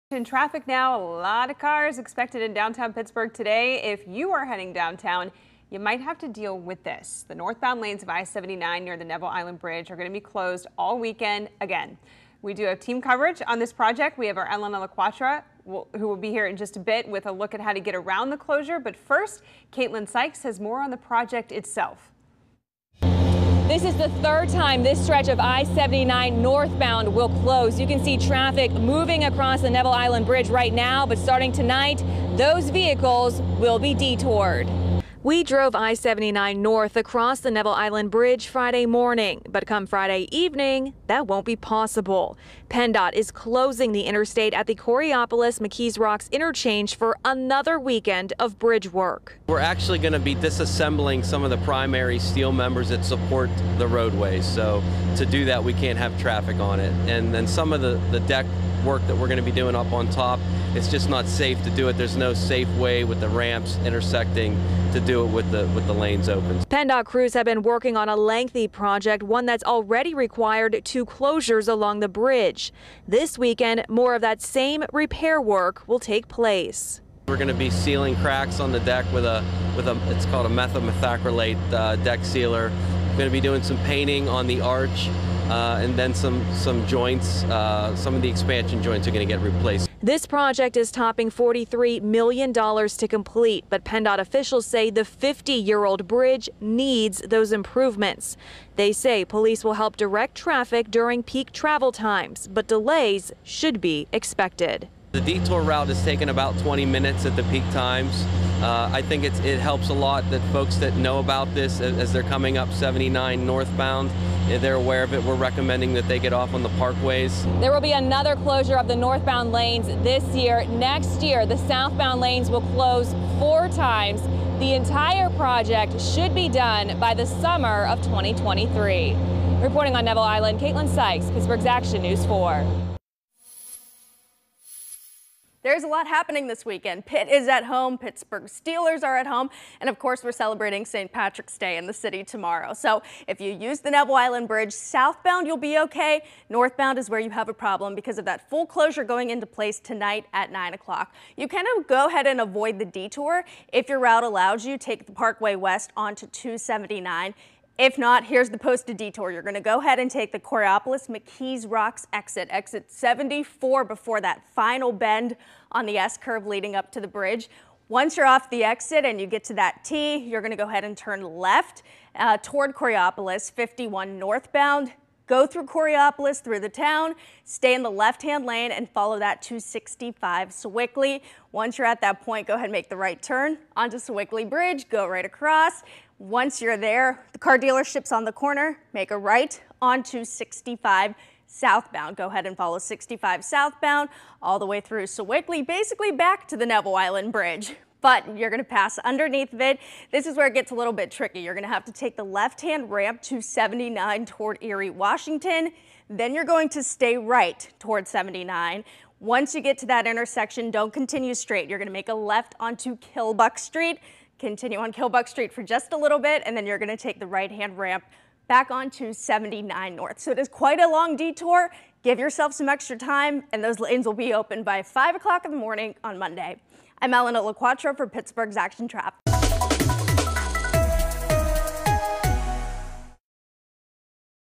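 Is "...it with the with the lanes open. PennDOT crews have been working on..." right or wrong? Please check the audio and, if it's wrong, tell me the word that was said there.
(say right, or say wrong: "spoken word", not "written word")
right.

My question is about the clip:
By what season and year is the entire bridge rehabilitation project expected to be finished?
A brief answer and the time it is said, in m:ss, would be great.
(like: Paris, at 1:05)
summer of 2023, at 2:07.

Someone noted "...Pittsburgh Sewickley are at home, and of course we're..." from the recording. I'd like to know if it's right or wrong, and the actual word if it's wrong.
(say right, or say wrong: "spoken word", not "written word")
wrong: "Steelers", not "Sewickley".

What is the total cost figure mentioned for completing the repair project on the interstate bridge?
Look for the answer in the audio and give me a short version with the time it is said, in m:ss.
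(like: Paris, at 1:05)
$43 million, at 1:31.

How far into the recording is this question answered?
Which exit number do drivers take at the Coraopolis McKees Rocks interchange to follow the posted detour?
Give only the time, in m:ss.
2:42.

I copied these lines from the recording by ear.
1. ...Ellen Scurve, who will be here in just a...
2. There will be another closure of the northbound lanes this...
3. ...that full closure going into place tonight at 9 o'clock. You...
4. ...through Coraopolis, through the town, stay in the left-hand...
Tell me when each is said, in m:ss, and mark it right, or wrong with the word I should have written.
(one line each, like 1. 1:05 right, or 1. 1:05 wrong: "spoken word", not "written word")
1. 0:14 wrong: "LaQuatra", not "Scurve"
2. 1:57 right
3. 2:28 right
4. 2:55 right.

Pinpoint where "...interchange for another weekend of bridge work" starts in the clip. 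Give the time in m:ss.
0:46.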